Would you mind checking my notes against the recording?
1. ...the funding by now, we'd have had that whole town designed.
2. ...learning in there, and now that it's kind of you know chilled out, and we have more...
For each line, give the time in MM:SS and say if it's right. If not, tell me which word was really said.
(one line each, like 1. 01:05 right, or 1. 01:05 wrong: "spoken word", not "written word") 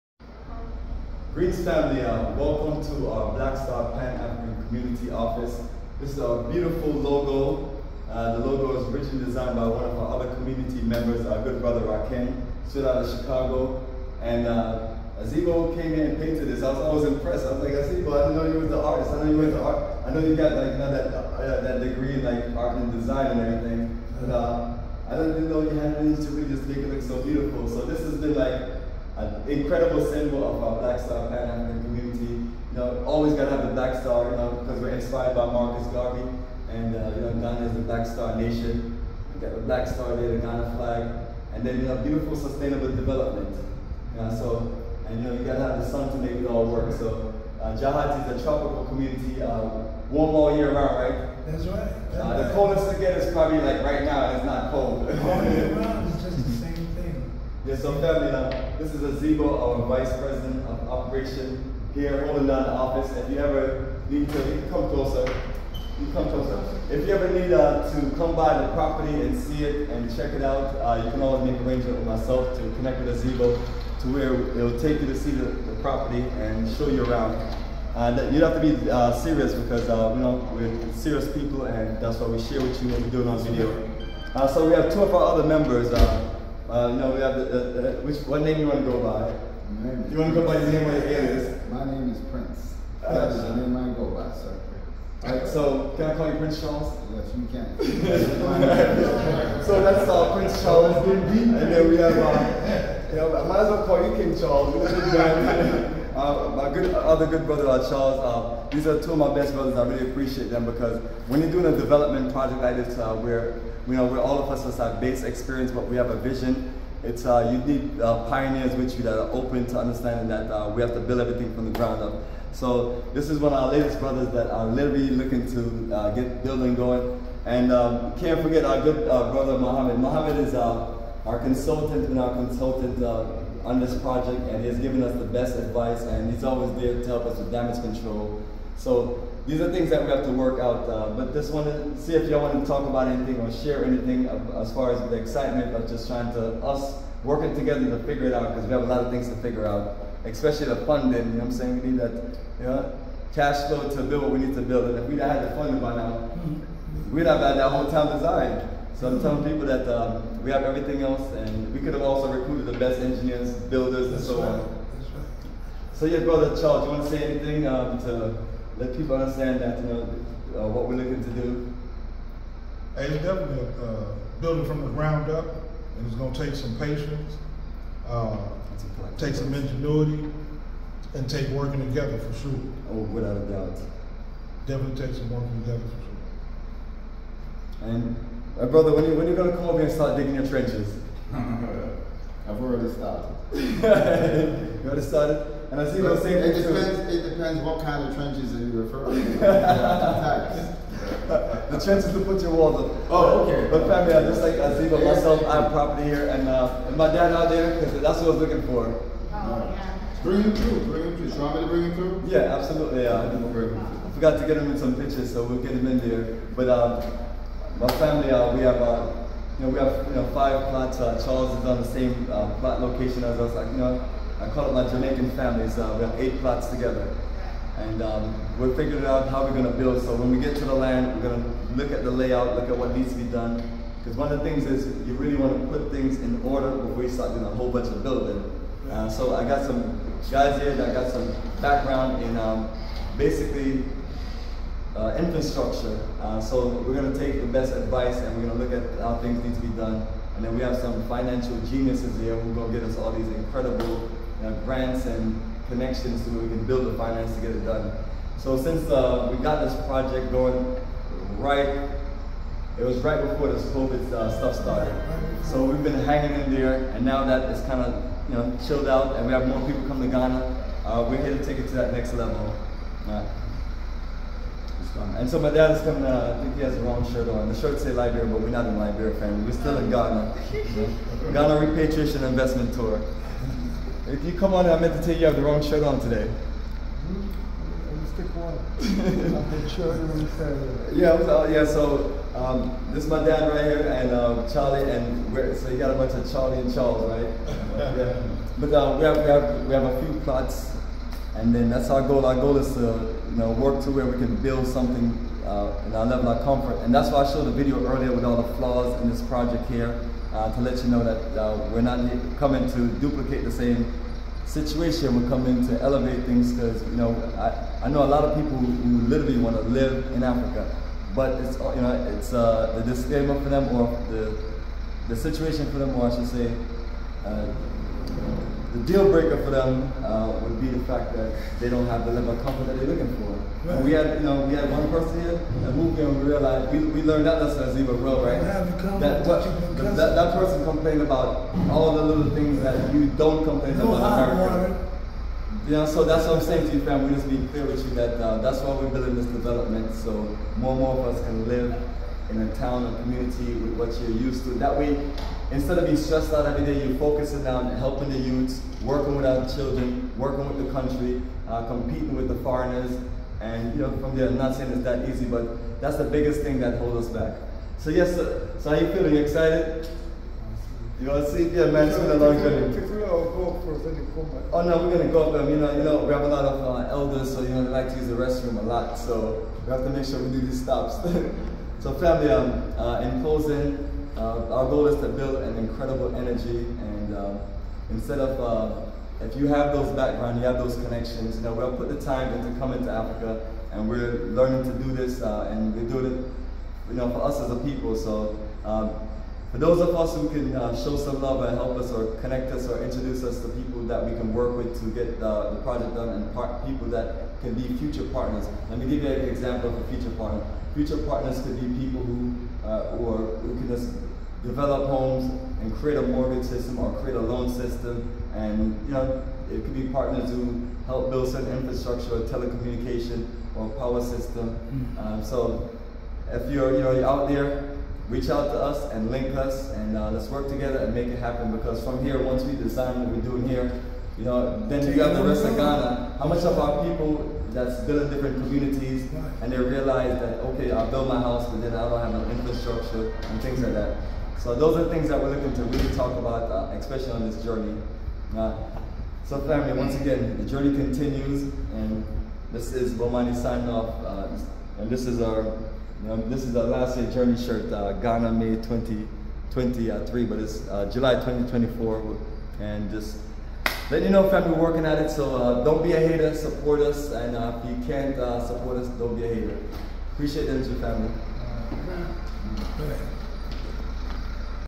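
1. 02:35 right
2. 04:26 wrong: "hanging", not "learning".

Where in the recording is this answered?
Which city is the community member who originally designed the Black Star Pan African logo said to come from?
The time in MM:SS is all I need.
00:13.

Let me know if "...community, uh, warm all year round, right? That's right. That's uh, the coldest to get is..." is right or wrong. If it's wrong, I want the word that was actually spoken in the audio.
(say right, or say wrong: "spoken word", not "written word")
right.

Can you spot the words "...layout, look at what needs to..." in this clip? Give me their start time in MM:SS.
03:52.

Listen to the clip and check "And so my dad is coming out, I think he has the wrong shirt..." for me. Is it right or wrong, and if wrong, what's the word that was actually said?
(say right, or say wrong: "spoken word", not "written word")
right.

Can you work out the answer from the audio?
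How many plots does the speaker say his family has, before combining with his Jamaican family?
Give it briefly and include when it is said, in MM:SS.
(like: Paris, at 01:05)
5, at 03:40.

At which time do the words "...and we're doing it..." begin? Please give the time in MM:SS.
06:35.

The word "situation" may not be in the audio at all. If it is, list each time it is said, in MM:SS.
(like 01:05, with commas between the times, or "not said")
05:14, 05:25.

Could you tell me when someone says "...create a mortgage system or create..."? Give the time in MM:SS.
06:55.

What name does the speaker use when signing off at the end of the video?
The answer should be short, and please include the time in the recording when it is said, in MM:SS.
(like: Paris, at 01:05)
Bomani, at 07:32.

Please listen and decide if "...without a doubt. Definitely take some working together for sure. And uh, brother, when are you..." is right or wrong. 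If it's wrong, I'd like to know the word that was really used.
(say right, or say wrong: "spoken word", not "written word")
right.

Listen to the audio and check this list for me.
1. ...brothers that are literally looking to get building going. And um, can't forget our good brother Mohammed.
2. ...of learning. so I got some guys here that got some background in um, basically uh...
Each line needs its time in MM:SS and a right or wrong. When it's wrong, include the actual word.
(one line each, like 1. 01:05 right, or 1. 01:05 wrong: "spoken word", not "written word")
1. 02:03 right
2. 03:57 wrong: "building", not "learning".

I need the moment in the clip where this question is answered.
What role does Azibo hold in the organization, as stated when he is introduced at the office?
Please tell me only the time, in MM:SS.
00:59.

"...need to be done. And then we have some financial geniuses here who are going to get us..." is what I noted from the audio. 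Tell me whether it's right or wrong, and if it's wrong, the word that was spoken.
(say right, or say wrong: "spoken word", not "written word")
right.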